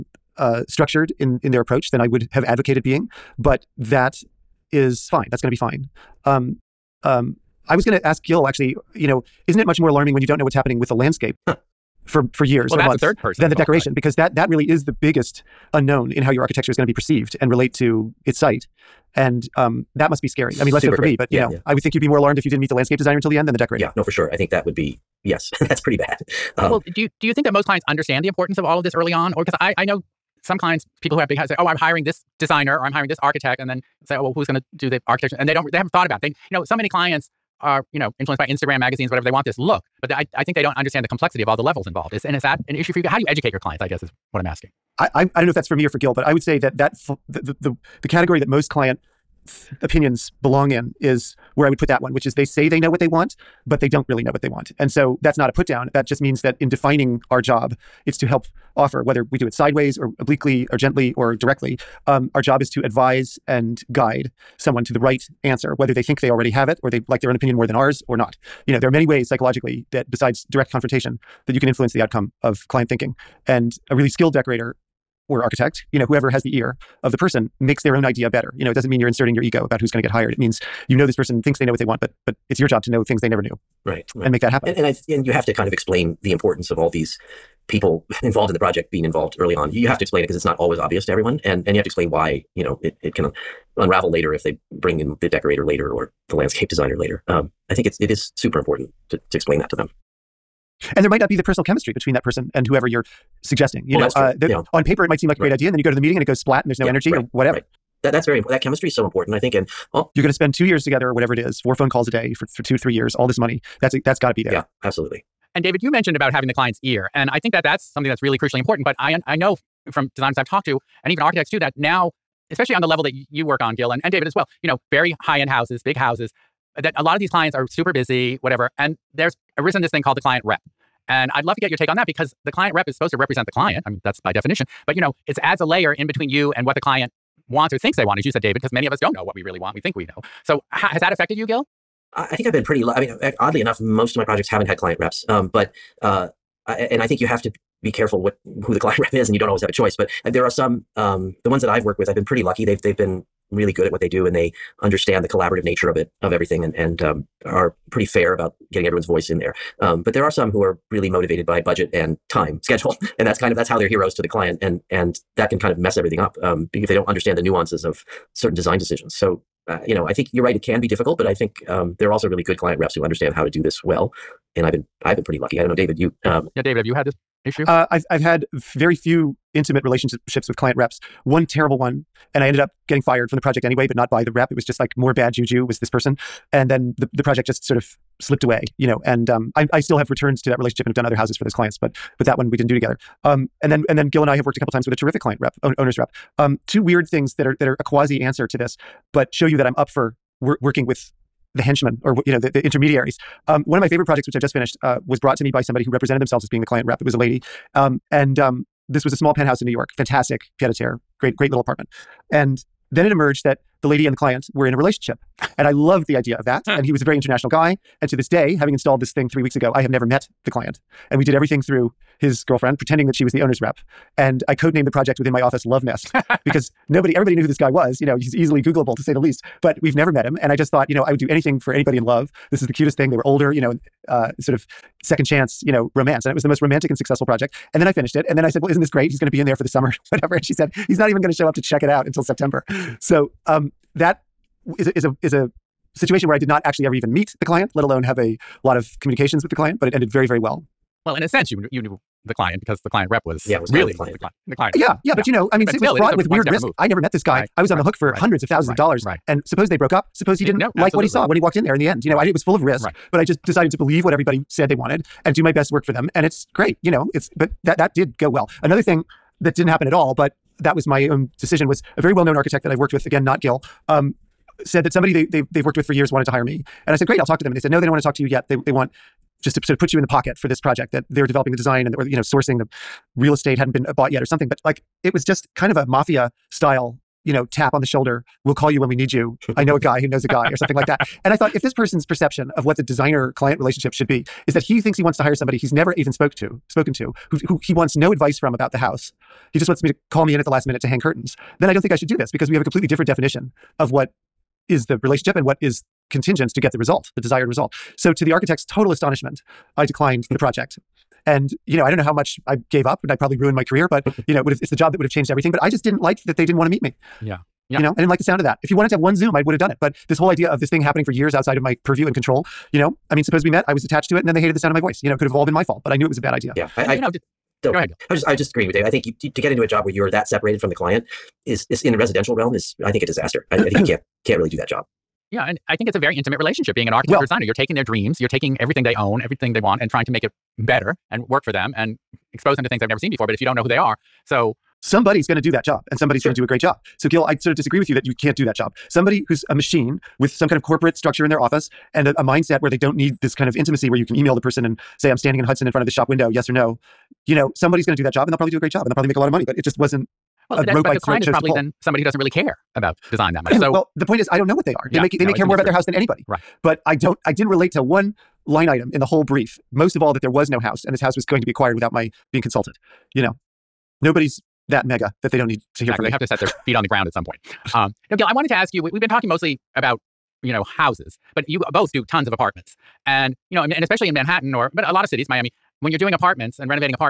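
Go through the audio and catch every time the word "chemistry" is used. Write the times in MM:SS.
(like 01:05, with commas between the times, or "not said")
01:41, 01:48.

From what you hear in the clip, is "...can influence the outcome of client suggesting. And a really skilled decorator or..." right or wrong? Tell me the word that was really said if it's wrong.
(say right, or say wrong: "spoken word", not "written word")
wrong: "thinking", not "suggesting".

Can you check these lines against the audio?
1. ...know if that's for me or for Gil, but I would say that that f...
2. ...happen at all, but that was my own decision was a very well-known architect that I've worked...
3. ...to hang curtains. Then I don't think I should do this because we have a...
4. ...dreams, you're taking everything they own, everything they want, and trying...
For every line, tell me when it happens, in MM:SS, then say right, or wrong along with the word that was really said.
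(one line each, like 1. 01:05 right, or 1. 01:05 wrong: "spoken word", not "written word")
1. 00:45 right
2. 04:29 right
3. 05:00 right
4. 05:37 right.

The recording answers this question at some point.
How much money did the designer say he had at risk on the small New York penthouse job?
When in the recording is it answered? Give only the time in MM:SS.
04:18.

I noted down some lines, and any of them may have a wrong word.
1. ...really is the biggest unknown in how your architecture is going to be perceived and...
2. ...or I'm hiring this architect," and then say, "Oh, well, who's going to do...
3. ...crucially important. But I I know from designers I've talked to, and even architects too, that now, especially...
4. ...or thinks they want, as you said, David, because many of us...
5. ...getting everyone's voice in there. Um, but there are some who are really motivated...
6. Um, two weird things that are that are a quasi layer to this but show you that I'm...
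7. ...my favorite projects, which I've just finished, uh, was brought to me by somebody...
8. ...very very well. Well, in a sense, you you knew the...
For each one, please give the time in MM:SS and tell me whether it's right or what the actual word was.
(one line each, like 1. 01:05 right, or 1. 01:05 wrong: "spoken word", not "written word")
1. 00:14 right
2. 00:32 right
3. 01:58 right
4. 02:17 right
5. 02:38 right
6. 03:16 wrong: "answer", not "layer"
7. 03:23 right
8. 04:10 right.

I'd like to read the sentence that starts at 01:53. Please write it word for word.
That's a, that's got to be there.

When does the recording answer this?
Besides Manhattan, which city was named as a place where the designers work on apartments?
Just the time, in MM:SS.
06:25.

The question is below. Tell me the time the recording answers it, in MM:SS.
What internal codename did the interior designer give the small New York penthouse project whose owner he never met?
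03:45.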